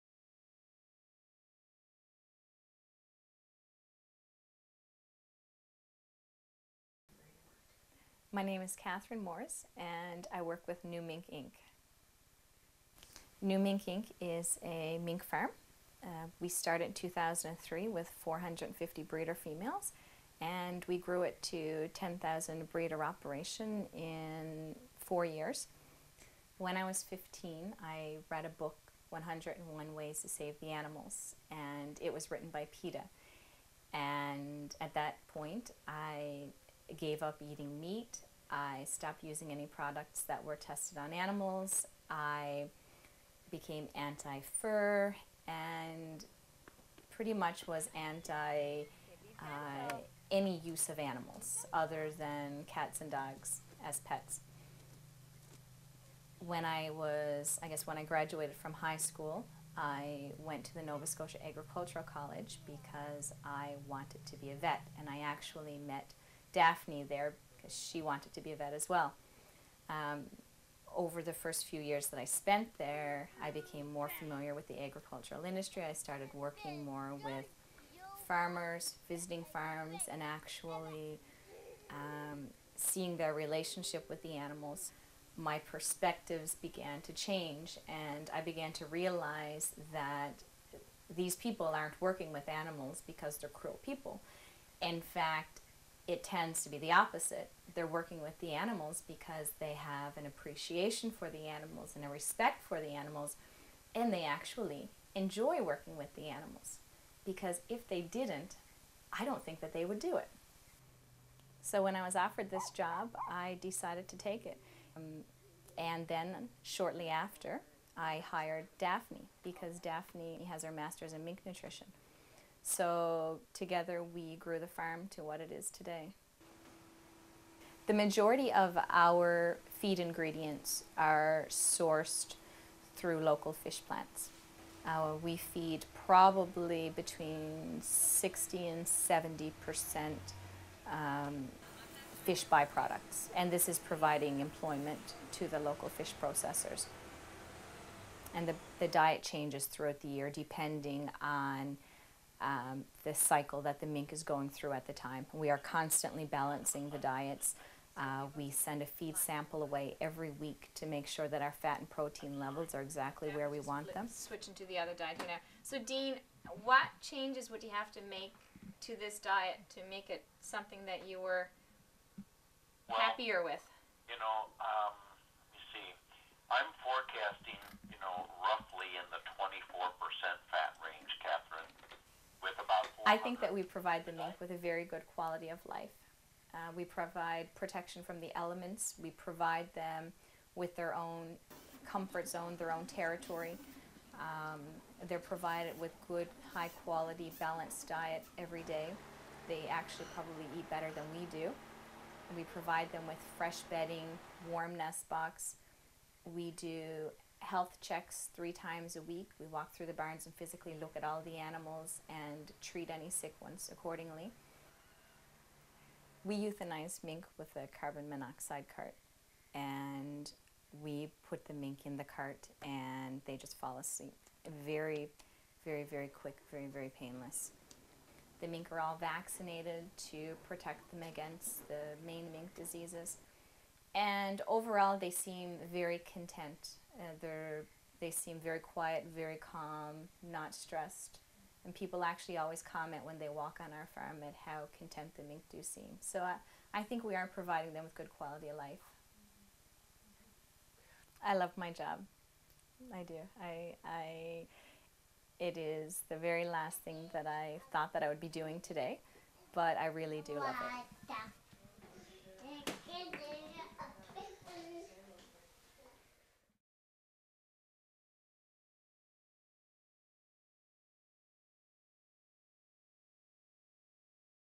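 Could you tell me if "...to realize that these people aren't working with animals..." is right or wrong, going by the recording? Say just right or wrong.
right.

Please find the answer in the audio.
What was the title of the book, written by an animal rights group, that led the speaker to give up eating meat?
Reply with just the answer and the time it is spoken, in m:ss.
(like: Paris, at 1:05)
101 Ways to Save the Animals, at 0:29.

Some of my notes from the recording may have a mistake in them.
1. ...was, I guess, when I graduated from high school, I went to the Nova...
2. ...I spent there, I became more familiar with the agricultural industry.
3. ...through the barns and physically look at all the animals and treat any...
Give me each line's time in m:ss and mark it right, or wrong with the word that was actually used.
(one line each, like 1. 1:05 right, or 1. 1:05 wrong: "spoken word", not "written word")
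1. 0:56 right
2. 1:12 right
3. 3:29 right.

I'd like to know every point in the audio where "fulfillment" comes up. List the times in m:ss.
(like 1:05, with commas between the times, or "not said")
not said.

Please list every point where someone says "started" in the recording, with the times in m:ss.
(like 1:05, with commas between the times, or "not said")
0:16, 1:15.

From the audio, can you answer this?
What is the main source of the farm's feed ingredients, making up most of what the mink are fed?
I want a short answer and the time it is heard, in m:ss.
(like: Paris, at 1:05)
Local fish plants, at 2:13.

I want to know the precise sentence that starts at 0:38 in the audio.
I stopped using any products that were tested on animals.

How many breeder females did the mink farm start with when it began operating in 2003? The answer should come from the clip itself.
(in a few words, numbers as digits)
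450.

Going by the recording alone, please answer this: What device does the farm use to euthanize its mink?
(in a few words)
Carbon monoxide cart.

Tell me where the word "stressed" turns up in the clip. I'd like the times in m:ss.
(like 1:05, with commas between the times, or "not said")
4:00.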